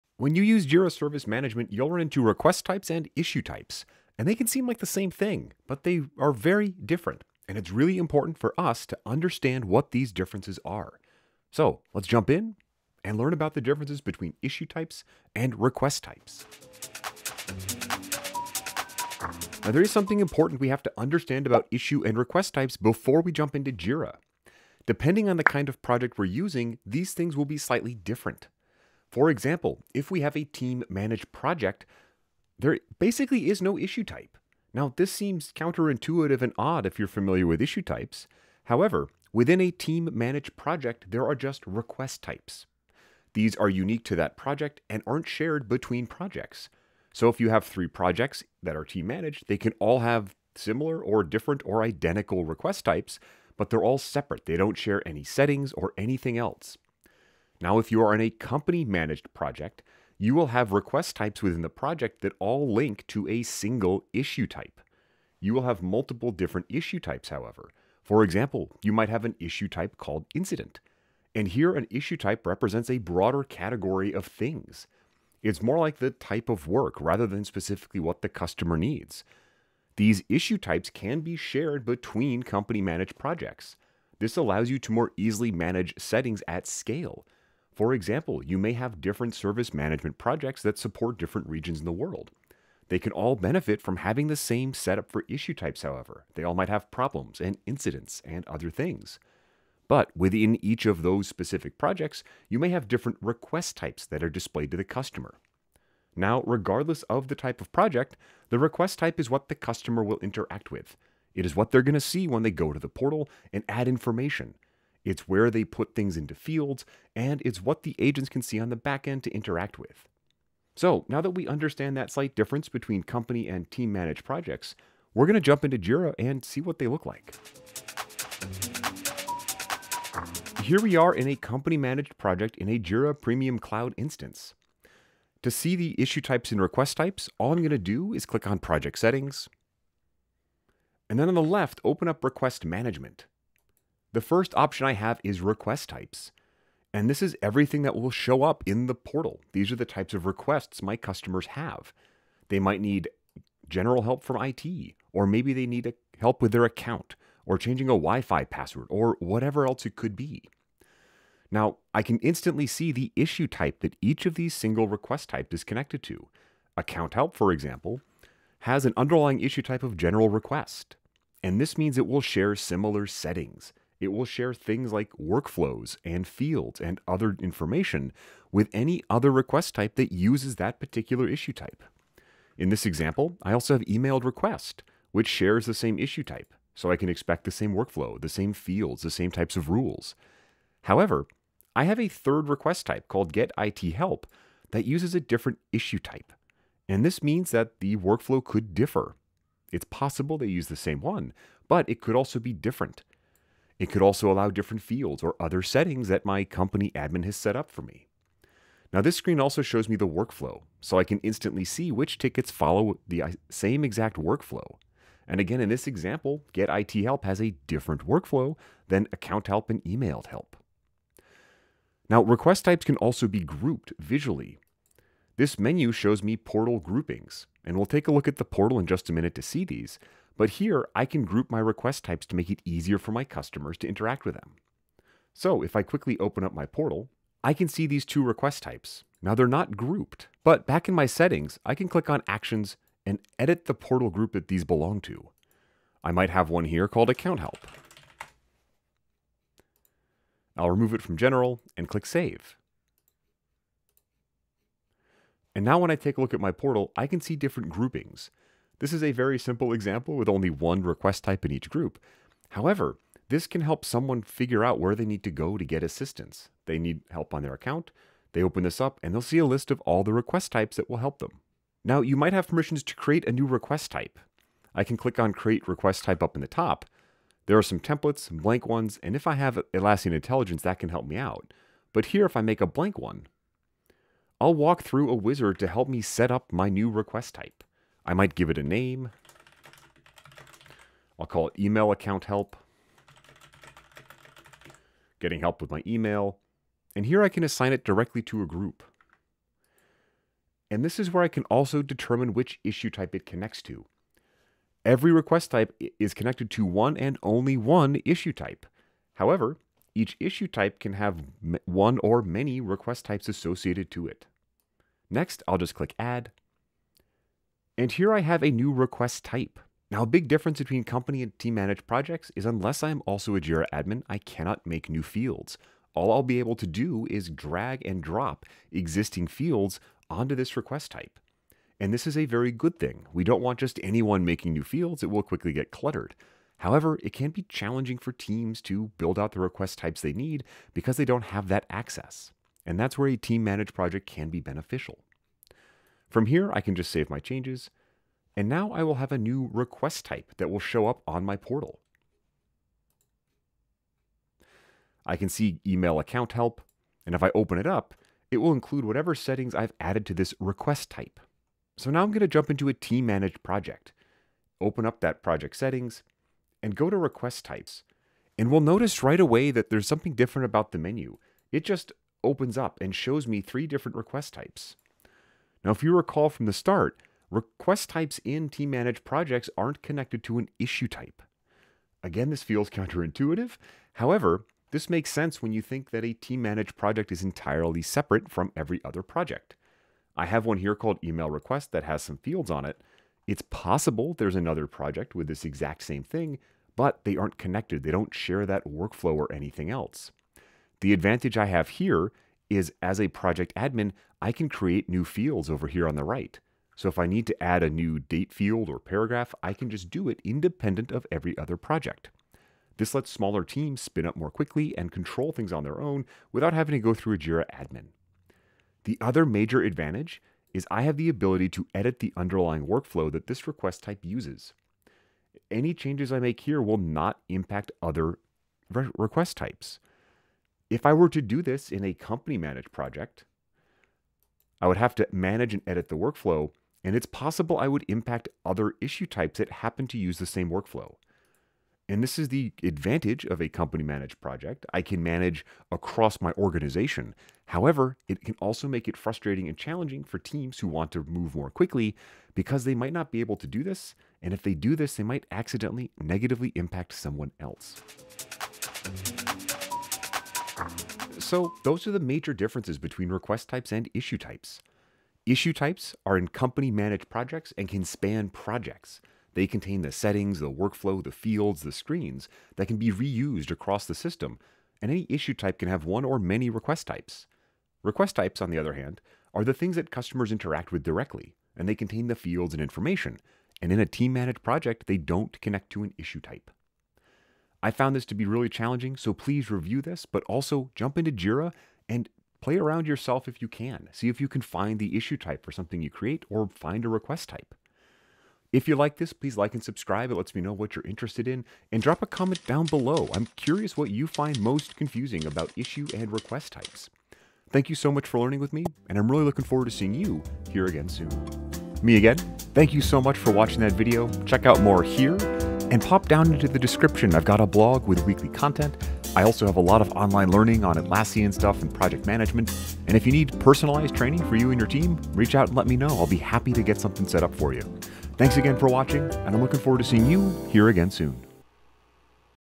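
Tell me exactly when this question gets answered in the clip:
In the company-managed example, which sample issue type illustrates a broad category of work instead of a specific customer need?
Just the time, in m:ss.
1:10.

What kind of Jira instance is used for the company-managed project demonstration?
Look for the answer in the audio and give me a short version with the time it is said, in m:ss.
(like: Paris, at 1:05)
Jira Premium Cloud, at 2:12.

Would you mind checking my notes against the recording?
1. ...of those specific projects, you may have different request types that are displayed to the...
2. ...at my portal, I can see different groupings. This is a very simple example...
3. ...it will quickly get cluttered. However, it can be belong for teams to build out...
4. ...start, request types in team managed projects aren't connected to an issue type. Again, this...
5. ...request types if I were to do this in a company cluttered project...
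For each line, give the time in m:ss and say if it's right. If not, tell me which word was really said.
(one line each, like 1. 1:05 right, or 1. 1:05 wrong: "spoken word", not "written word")
1. 1:40 right
2. 4:16 right
3. 5:35 wrong: "challenging", not "belong"
4. 6:16 right
5. 7:08 wrong: "managed", not "cluttered".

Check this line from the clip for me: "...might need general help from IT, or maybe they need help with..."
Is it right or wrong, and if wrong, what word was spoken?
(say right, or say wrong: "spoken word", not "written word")
right.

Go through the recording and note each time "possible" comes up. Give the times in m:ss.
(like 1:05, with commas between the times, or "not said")
3:19, 6:33, 7:17.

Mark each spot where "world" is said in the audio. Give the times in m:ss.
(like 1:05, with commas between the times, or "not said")
1:31.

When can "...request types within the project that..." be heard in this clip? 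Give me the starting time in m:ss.
1:00.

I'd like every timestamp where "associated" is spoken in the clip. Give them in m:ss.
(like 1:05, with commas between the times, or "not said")
5:13.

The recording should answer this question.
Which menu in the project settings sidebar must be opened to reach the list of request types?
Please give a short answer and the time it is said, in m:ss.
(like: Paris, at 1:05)
Request Management, at 2:22.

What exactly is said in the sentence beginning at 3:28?
Now this screen also shows me the workflow, so I can instantly see which tickets follow the uh, same exact workflow.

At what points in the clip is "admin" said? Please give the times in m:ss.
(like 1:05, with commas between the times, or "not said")
3:26, 5:23, 6:43, 6:57.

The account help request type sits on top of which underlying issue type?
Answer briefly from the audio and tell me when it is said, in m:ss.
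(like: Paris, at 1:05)
general request, at 2:49.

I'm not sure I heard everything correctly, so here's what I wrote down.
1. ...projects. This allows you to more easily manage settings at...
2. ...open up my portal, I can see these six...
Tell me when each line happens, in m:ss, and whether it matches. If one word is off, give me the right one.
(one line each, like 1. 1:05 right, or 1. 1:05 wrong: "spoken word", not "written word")
1. 1:23 right
2. 3:56 wrong: "two", not "six".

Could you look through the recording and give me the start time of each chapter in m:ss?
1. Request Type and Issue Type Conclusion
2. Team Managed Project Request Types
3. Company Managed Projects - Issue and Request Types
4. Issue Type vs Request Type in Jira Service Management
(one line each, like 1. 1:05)
1. 7:40
2. 6:01
3. 2:10
4. 0:19.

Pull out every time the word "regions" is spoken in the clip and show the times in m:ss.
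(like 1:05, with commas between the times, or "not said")
1:31.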